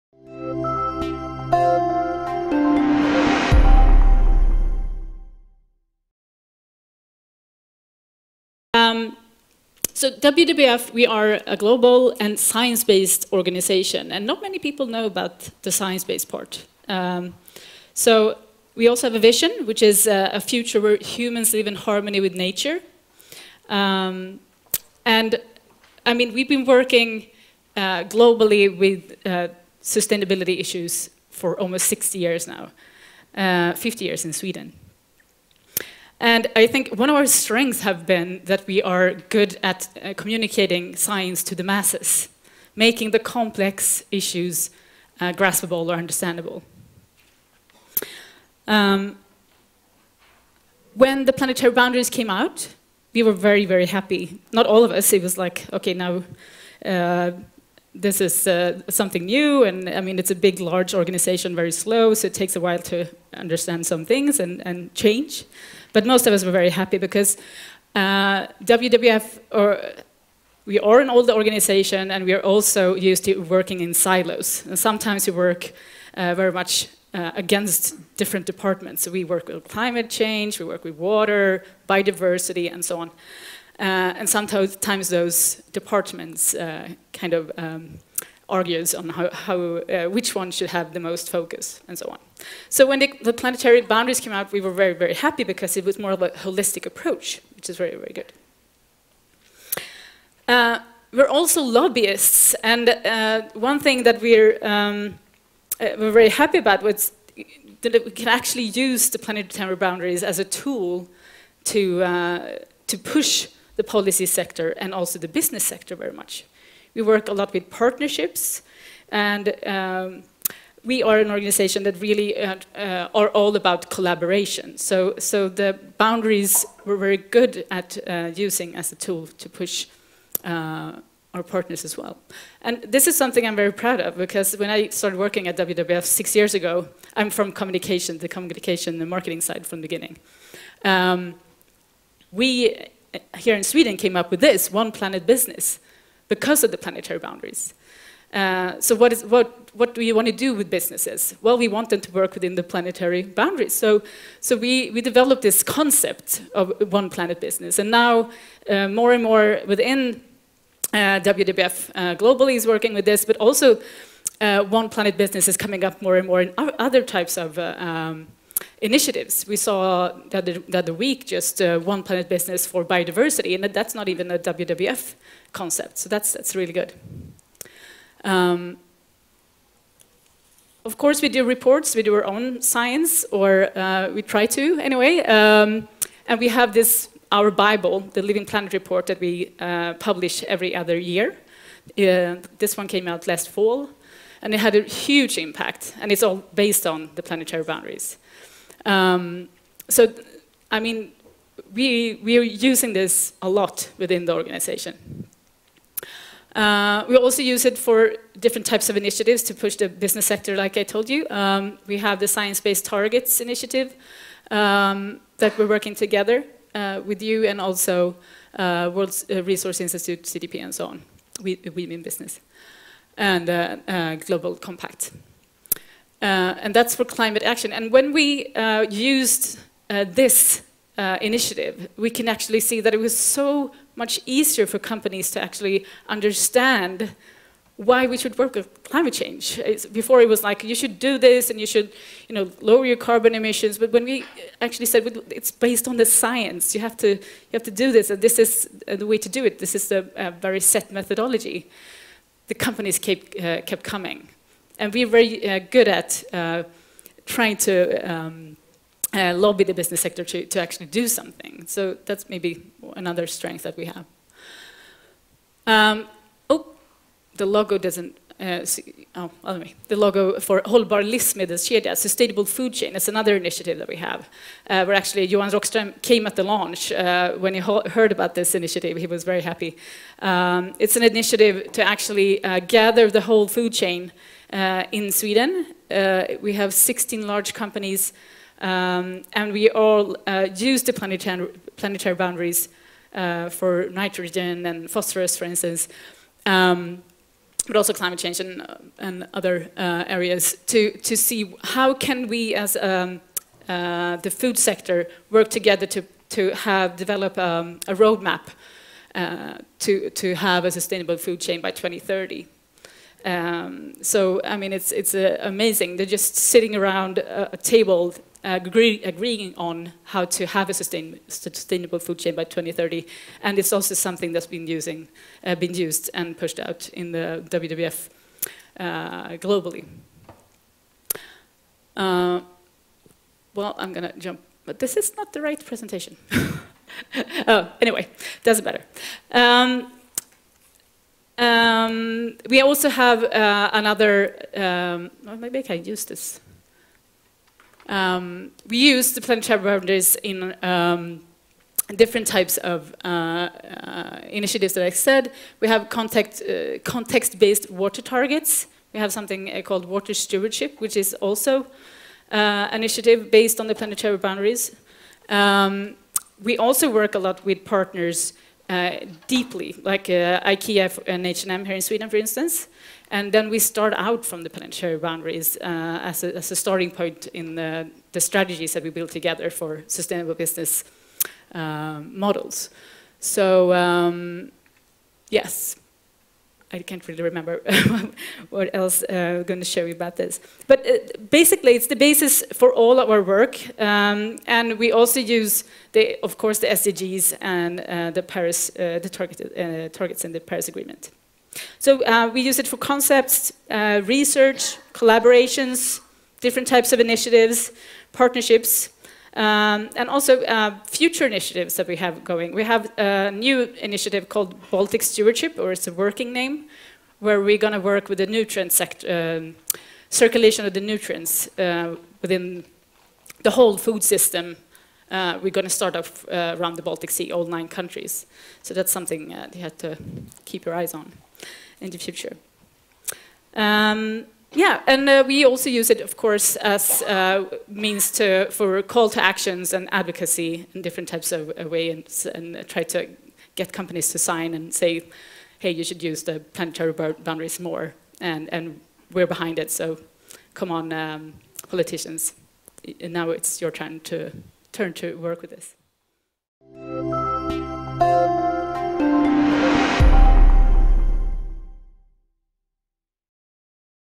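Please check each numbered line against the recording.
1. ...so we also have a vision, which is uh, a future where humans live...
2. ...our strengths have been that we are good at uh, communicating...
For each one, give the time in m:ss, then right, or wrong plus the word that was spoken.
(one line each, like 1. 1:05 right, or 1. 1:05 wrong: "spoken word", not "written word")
1. 0:17 right
2. 0:37 right.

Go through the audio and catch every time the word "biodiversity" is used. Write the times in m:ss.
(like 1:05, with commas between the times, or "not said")
1:21, 2:52.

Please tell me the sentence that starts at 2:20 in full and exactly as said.
Um, we here in Sweden came up with this, one planet business, because of the planetary boundaries.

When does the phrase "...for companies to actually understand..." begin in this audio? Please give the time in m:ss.
3:54.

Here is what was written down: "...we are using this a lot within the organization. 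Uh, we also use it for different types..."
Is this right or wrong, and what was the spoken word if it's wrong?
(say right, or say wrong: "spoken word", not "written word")
right.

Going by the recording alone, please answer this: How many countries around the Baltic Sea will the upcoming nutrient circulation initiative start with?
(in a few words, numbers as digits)
9.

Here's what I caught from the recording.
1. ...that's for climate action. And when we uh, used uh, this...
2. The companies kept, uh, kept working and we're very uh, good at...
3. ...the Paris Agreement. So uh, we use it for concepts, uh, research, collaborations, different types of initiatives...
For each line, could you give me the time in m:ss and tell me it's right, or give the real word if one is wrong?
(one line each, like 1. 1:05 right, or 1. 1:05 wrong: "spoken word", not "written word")
1. 3:46 right
2. 4:12 wrong: "coming", not "working"
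3. 6:40 right.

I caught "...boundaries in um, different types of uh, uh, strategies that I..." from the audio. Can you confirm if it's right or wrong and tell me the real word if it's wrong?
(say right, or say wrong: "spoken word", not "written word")
wrong: "initiatives", not "strategies".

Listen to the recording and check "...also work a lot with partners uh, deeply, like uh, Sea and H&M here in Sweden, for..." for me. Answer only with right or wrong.
wrong.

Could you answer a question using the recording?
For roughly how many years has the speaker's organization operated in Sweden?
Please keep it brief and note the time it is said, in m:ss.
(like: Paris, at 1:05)
50 years, at 0:33.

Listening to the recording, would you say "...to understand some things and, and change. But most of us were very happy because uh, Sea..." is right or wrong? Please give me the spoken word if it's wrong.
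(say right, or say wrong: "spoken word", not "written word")
wrong: "WWF", not "Sea".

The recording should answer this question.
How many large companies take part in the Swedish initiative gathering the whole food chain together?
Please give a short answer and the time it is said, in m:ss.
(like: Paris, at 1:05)
16, at 4:46.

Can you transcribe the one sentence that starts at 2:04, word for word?
So, so the boundaries we're very good at uh, using as a tool to push uh, our partners as well.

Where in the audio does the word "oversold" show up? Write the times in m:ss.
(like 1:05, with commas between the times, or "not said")
not said.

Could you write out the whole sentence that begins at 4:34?
Uh, where actually Johan Rockström came at the launch uh, when he heard about this initiative, he was very happy.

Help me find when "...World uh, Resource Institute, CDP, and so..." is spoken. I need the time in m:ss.
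3:38.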